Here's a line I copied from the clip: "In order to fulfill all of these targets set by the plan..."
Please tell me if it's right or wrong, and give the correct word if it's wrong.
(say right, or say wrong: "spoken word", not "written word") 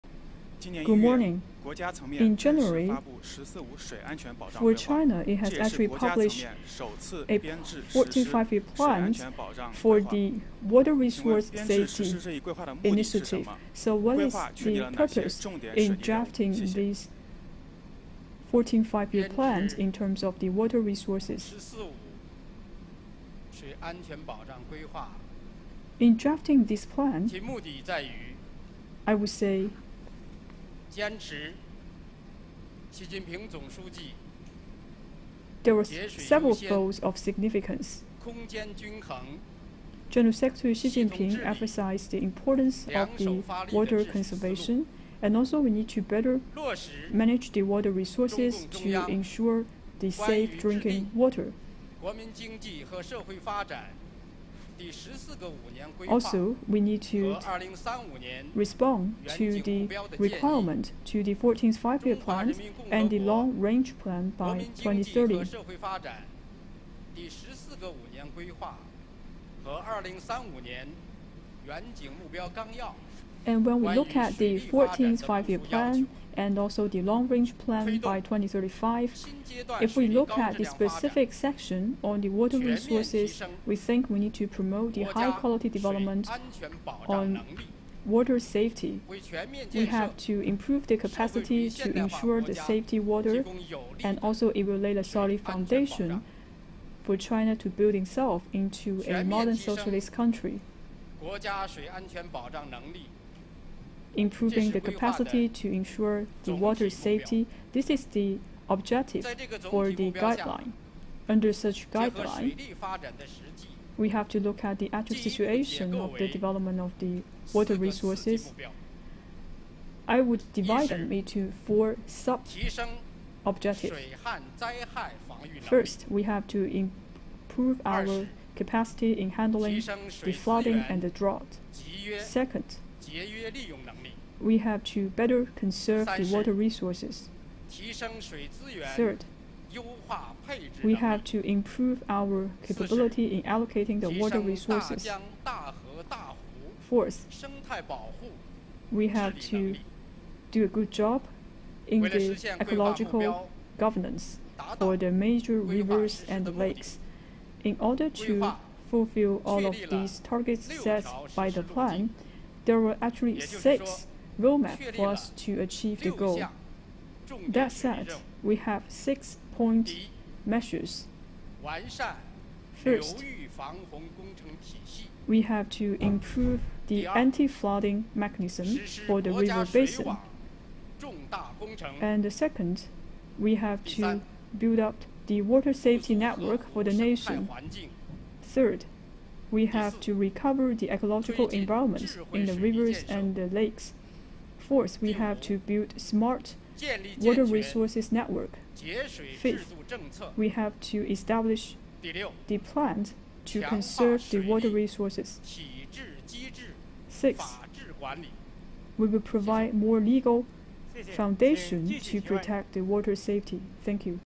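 right.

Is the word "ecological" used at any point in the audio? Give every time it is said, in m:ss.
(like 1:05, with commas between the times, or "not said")
2:32, 3:10.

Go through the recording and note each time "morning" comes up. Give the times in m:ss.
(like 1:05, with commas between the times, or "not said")
0:00.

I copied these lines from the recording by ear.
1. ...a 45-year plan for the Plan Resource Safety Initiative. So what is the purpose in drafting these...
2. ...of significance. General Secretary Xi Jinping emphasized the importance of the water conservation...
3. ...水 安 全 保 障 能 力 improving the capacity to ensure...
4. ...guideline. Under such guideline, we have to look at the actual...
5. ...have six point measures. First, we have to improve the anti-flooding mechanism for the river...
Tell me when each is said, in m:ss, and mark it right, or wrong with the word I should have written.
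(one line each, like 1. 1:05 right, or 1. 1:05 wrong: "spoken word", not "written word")
1. 0:07 wrong: "Water", not "Plan"
2. 0:36 right
3. 1:41 right
4. 1:50 right
5. 2:48 right.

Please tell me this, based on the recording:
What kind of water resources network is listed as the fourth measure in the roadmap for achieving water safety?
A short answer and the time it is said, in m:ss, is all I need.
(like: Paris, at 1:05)
smart, at 3:15.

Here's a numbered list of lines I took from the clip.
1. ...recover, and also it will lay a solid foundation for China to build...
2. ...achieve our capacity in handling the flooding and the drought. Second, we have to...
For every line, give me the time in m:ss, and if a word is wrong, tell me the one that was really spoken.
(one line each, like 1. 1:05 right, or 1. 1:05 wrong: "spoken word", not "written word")
1. 1:32 wrong: "water", not "recover"
2. 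2:06 wrong: "improve", not "achieve".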